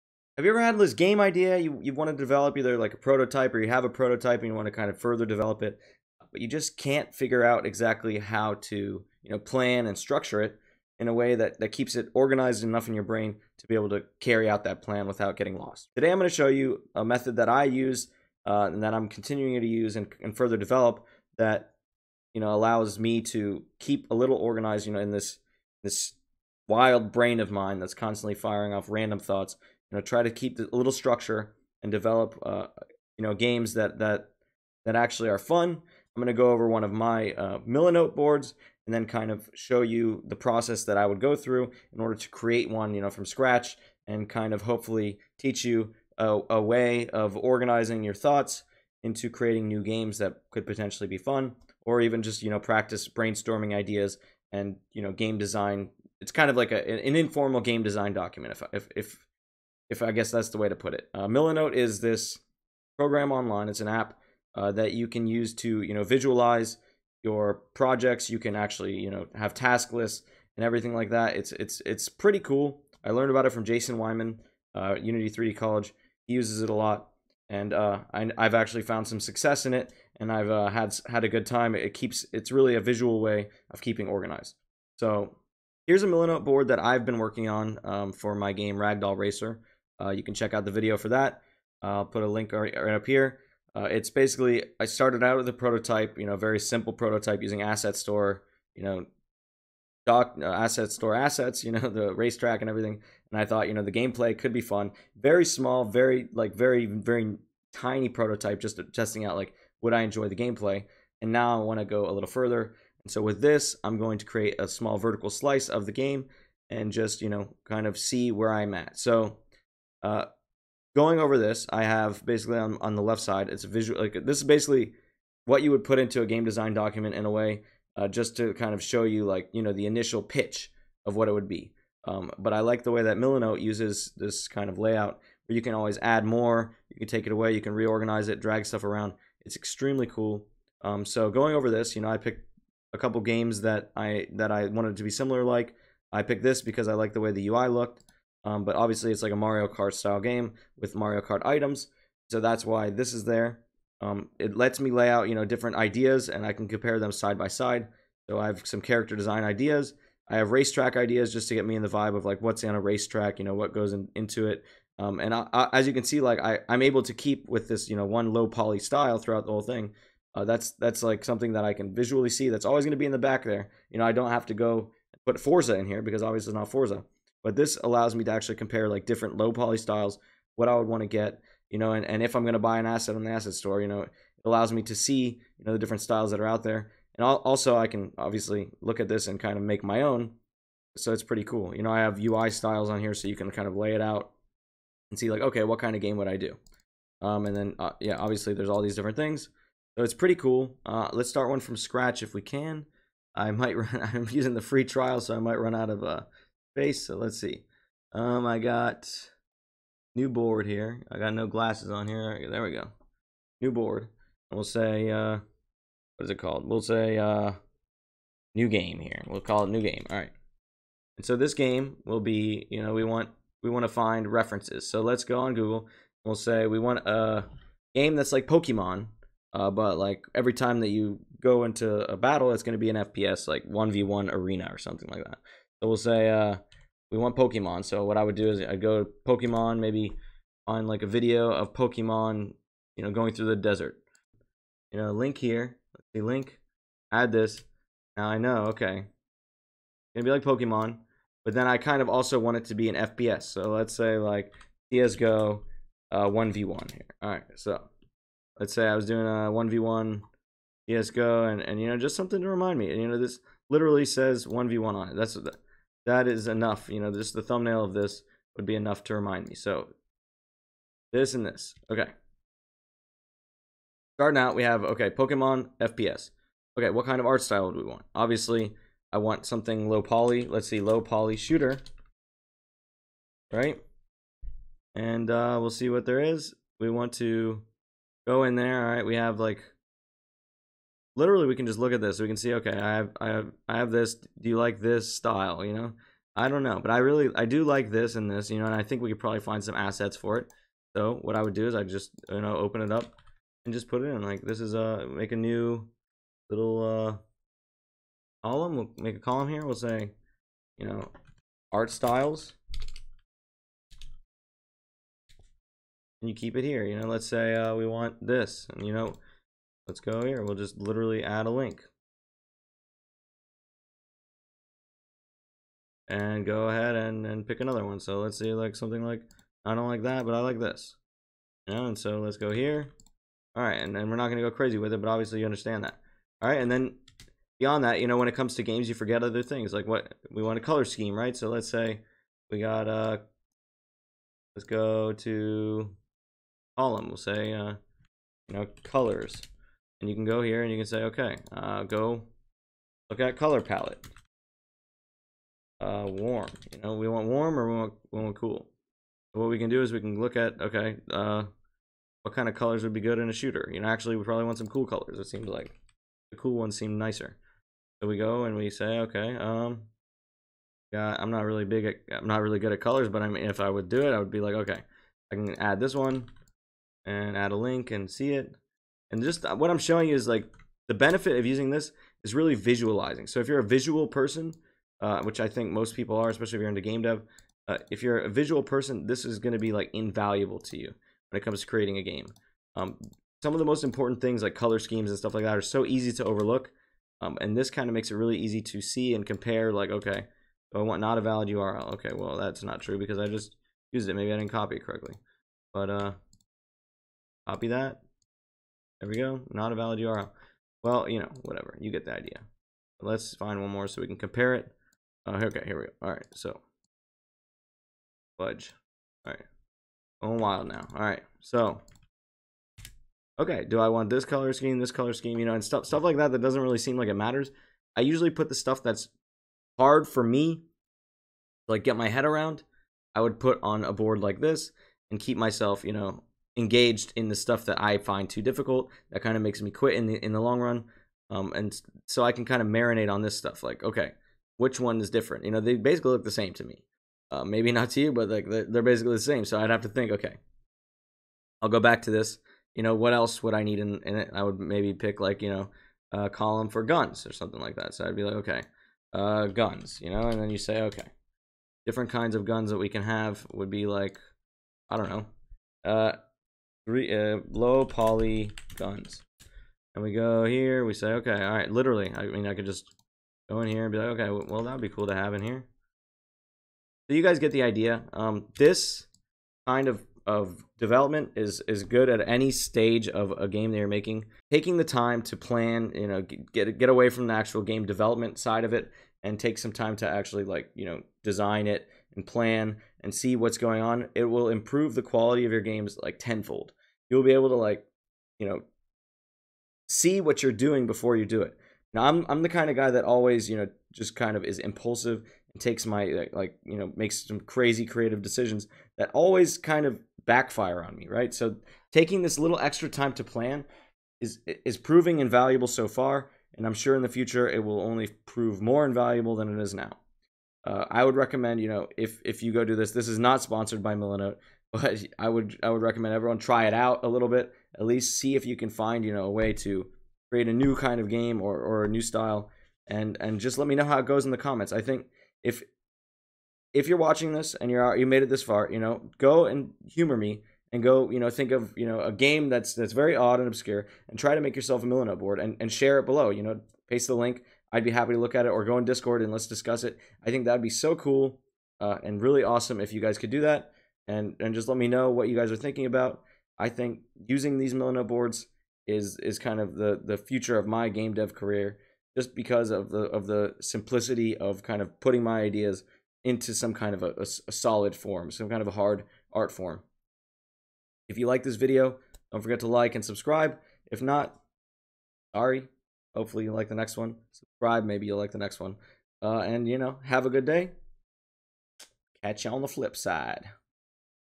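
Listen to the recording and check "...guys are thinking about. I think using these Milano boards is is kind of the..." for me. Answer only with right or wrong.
right.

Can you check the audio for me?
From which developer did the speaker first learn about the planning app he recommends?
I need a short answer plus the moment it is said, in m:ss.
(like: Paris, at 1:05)
Jason Weimann, at 1:13.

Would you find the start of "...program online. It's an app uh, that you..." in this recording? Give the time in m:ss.
1:02.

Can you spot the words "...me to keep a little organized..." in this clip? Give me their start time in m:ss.
0:22.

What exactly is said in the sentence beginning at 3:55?
So we'll say uh, we want Pokemon.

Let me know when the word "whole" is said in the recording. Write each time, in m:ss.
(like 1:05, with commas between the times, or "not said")
2:49.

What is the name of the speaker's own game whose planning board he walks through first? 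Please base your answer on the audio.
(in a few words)
Ragdoll Racer.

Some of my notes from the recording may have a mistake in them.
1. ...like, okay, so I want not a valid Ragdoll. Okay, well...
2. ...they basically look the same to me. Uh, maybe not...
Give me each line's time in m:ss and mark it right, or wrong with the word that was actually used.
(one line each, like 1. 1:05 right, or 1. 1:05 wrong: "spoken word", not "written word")
1. 6:39 wrong: "URL", not "Ragdoll"
2. 7:25 right.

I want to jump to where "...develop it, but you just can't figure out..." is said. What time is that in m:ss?
0:05.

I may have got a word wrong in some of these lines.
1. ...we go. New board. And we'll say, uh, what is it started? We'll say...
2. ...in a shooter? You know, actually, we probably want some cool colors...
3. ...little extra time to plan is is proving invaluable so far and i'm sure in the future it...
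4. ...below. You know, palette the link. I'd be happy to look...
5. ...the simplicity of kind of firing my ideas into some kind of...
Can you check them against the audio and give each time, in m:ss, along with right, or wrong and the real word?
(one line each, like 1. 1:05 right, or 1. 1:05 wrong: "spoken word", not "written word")
1. 3:32 wrong: "called", not "started"
2. 6:03 right
3. 8:32 right
4. 9:06 wrong: "paste", not "palette"
5. 9:23 wrong: "putting", not "firing".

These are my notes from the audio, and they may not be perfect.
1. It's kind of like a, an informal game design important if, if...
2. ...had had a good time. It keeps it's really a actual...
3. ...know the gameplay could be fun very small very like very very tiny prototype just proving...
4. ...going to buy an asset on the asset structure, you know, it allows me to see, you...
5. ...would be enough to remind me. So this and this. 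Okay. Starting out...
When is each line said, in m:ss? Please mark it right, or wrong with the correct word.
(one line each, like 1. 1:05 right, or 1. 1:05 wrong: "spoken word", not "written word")
1. 0:56 wrong: "document", not "important"
2. 1:20 wrong: "visual", not "actual"
3. 1:43 wrong: "testing", not "proving"
4. 3:02 wrong: "store", not "structure"
5. 4:28 right.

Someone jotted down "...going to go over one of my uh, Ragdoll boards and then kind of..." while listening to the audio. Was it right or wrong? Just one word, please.
wrong.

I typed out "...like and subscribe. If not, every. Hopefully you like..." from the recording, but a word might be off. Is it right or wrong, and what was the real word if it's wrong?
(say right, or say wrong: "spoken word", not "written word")
wrong: "sorry", not "every".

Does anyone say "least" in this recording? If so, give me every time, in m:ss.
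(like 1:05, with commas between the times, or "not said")
8:47.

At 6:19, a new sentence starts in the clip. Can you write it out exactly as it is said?
And just uh, what I'm showing is like the benefit of using this is really visualizing.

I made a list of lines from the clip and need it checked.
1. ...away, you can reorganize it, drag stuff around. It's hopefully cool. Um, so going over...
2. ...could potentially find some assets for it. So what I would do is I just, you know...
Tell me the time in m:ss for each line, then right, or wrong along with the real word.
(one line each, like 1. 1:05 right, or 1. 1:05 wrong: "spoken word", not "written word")
1. 2:17 wrong: "extremely", not "hopefully"
2. 4:59 wrong: "probably", not "potentially".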